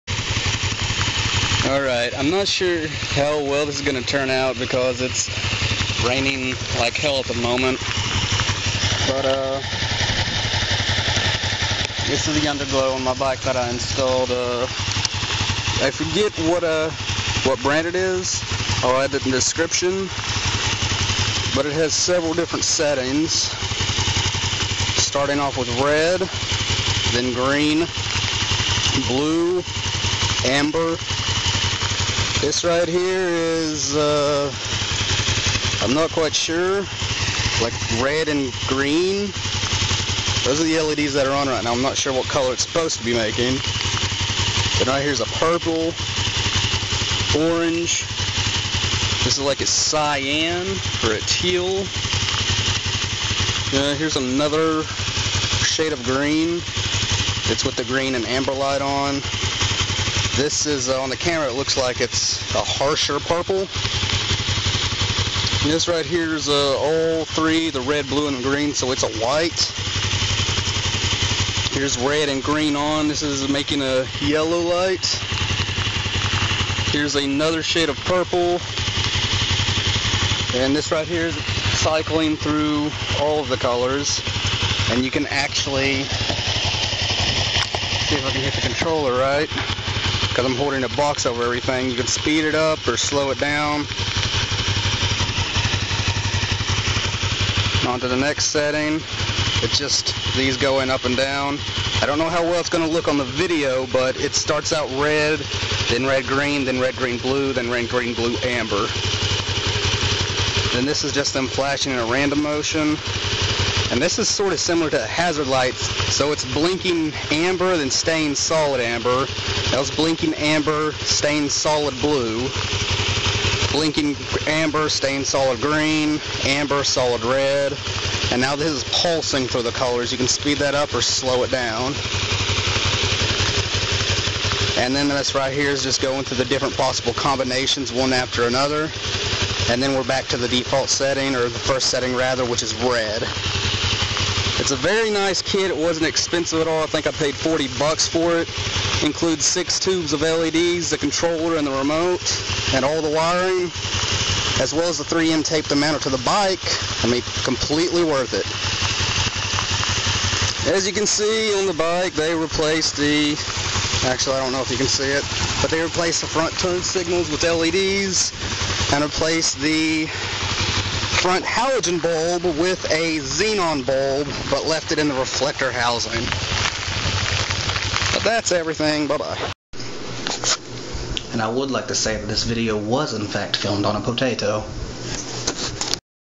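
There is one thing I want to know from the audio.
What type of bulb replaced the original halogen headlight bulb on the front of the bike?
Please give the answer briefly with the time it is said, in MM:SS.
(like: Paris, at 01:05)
xenon, at 02:53.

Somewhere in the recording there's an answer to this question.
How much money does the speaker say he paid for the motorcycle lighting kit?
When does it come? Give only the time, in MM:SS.
02:27.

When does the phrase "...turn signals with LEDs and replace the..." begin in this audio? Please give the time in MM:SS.
02:46.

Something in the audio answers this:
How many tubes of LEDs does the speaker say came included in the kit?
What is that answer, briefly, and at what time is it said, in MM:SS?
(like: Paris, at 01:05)
6, at 02:29.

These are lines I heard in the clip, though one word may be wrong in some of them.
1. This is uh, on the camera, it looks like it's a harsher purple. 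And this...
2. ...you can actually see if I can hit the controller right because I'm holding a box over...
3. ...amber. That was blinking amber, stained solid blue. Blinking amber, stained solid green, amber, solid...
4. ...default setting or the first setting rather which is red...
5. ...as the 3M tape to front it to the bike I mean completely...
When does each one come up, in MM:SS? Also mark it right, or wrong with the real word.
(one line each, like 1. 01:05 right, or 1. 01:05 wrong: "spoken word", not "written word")
1. 01:00 right
2. 01:25 right
3. 01:58 right
4. 02:20 right
5. 02:34 wrong: "mount", not "front".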